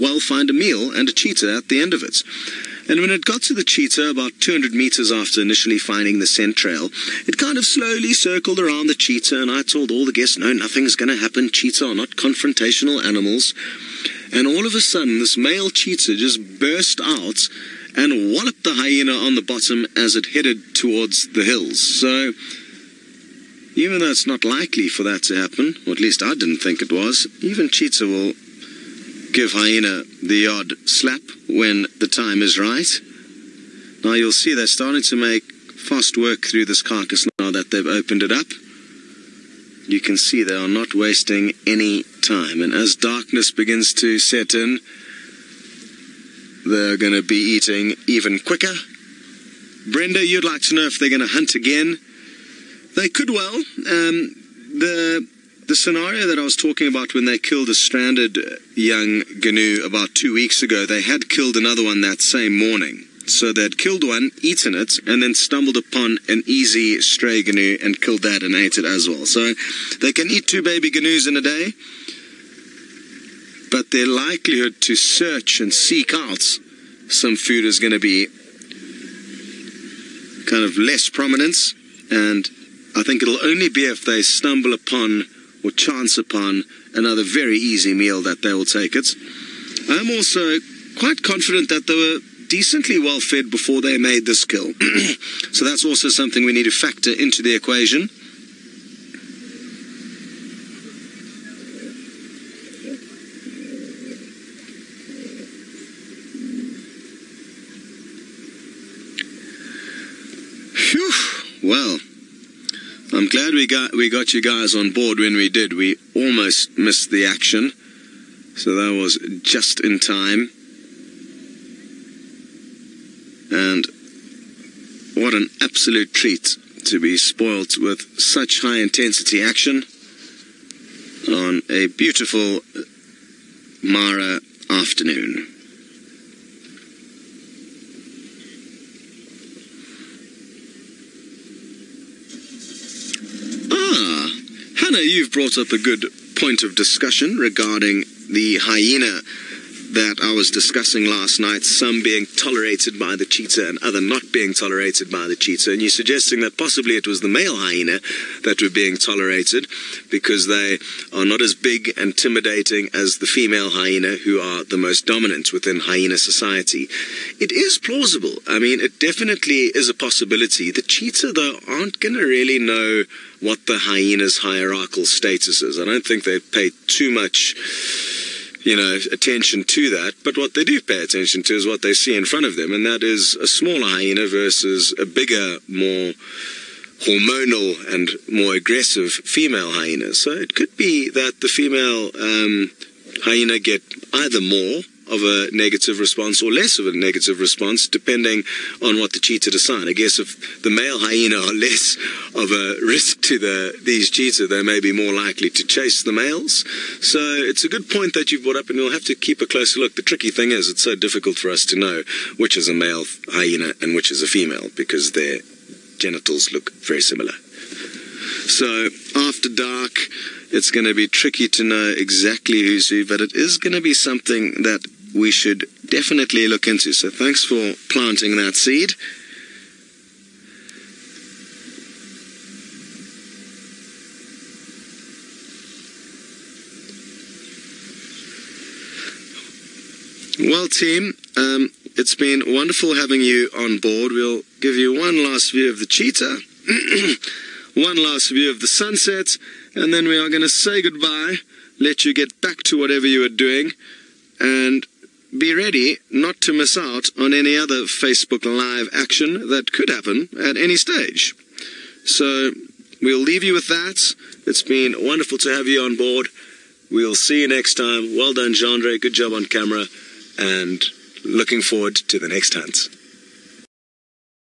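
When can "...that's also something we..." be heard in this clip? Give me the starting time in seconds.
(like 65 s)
95 s.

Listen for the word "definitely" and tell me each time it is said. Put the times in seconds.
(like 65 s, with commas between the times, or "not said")
169 s, 225 s.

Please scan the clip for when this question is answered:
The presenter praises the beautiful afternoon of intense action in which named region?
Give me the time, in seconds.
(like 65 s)
133 s.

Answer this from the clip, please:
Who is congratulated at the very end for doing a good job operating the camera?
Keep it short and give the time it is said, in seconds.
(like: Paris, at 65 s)
Jandre, at 268 s.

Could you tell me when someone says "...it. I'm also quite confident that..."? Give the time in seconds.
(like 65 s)
88 s.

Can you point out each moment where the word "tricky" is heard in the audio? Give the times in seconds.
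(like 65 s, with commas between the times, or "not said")
210 s, 221 s.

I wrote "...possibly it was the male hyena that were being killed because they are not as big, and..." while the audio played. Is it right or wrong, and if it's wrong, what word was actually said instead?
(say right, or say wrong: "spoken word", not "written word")
wrong: "tolerated", not "killed".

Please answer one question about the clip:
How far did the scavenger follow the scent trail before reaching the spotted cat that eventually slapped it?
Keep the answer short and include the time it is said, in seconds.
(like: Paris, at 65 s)
200 meters, at 4 s.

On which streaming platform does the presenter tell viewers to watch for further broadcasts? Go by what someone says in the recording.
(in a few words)
Facebook Live.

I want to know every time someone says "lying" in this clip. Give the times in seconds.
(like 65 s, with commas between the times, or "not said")
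not said.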